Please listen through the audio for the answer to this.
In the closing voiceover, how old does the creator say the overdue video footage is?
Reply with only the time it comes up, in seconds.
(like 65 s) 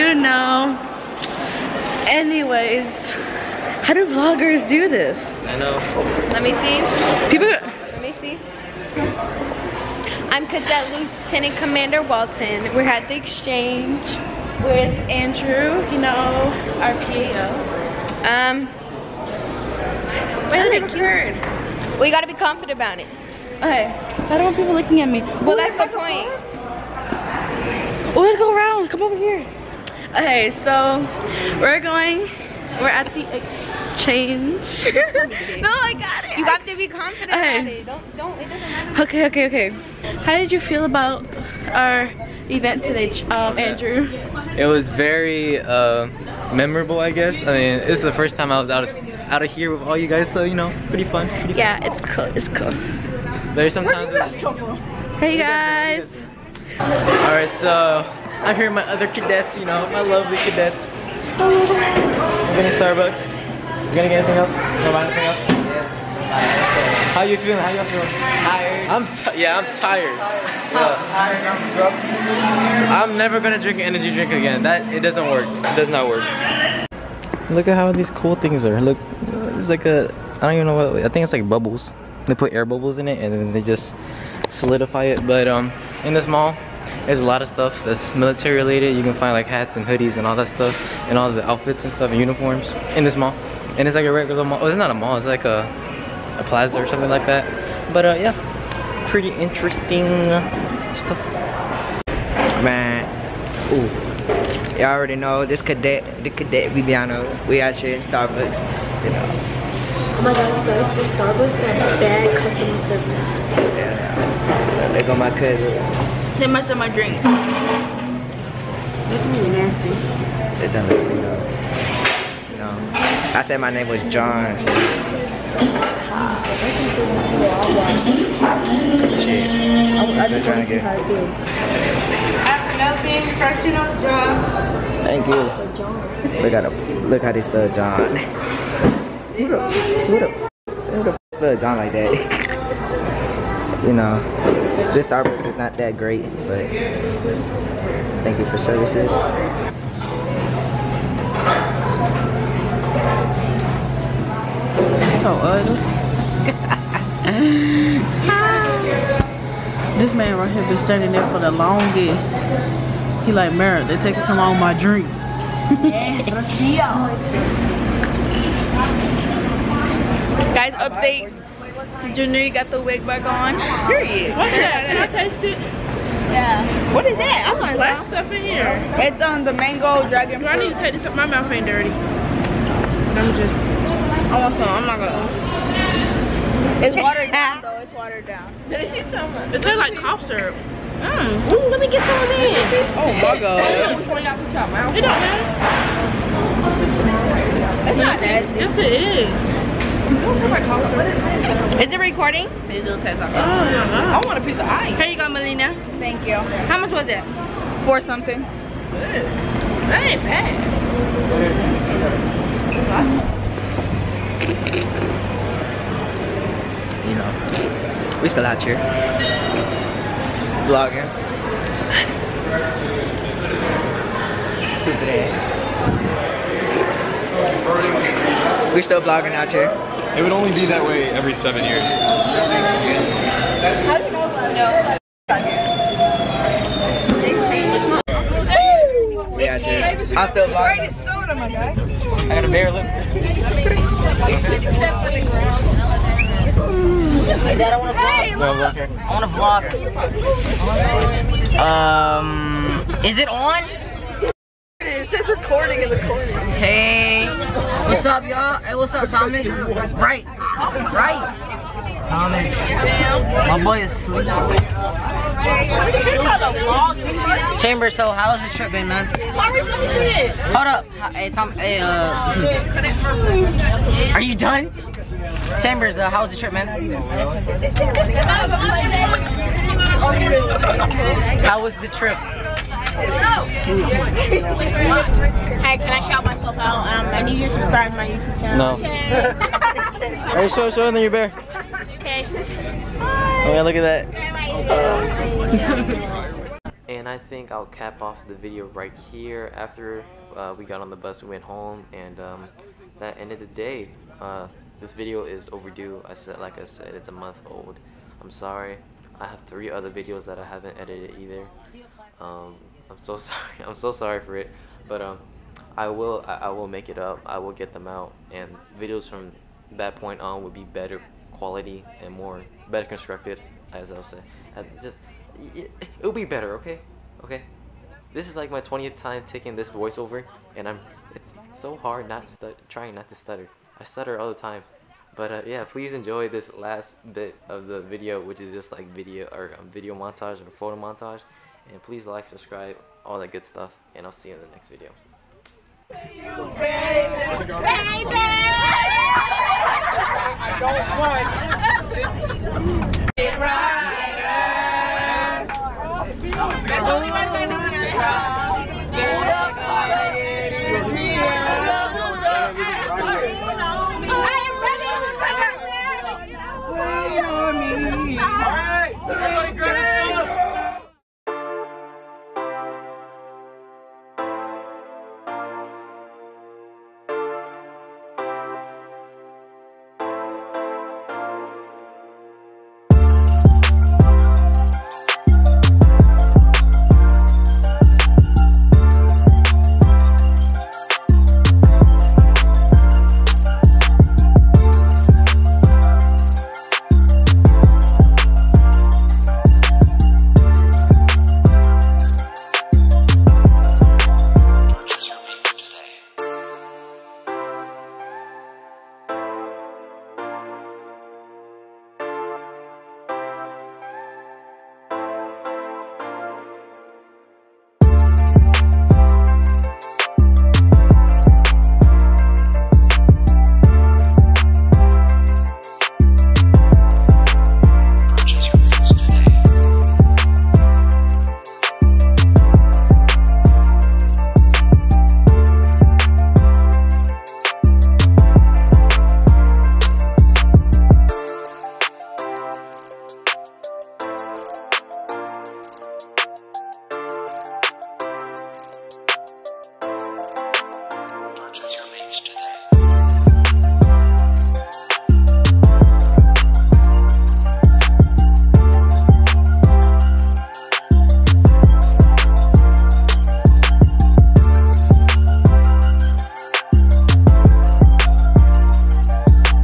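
307 s.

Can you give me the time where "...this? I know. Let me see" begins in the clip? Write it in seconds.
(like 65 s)
4 s.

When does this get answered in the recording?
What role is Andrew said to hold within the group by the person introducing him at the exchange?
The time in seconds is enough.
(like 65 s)
17 s.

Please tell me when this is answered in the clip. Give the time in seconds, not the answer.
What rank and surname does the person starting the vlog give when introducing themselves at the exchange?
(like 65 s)
10 s.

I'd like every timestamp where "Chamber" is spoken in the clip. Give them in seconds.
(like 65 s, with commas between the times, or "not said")
267 s, 275 s.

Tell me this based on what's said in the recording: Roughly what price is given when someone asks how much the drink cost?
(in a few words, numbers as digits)
Four something.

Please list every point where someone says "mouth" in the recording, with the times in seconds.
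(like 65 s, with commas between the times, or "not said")
181 s, 194 s.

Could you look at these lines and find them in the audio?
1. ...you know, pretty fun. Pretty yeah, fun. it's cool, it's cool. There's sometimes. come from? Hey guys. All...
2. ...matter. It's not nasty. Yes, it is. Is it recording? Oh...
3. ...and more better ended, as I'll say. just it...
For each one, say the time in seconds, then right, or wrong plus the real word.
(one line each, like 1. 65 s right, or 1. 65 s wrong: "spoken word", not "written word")
1. 50 s right
2. 195 s right
3. 322 s wrong: "constructed", not "ended".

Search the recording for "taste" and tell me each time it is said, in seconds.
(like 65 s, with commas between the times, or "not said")
175 s, 189 s.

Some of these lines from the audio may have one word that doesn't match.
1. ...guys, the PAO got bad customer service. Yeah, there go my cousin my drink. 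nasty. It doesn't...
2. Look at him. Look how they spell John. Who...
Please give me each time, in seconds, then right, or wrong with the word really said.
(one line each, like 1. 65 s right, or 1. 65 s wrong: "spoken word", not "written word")
1. 110 s wrong: "Starbucks", not "PAO"
2. 136 s right.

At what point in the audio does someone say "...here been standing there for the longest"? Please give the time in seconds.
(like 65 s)
160 s.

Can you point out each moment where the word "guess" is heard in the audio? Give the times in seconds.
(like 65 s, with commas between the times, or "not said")
47 s.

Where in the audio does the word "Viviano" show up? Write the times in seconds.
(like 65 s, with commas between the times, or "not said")
106 s.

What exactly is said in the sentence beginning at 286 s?
Um, I need you to subscribe to my YouTube channel.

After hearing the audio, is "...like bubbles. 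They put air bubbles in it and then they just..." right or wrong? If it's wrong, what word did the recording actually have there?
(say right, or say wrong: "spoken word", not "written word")
right.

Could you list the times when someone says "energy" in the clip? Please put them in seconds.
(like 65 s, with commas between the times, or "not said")
73 s.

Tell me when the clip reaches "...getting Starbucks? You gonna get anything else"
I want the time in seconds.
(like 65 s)
61 s.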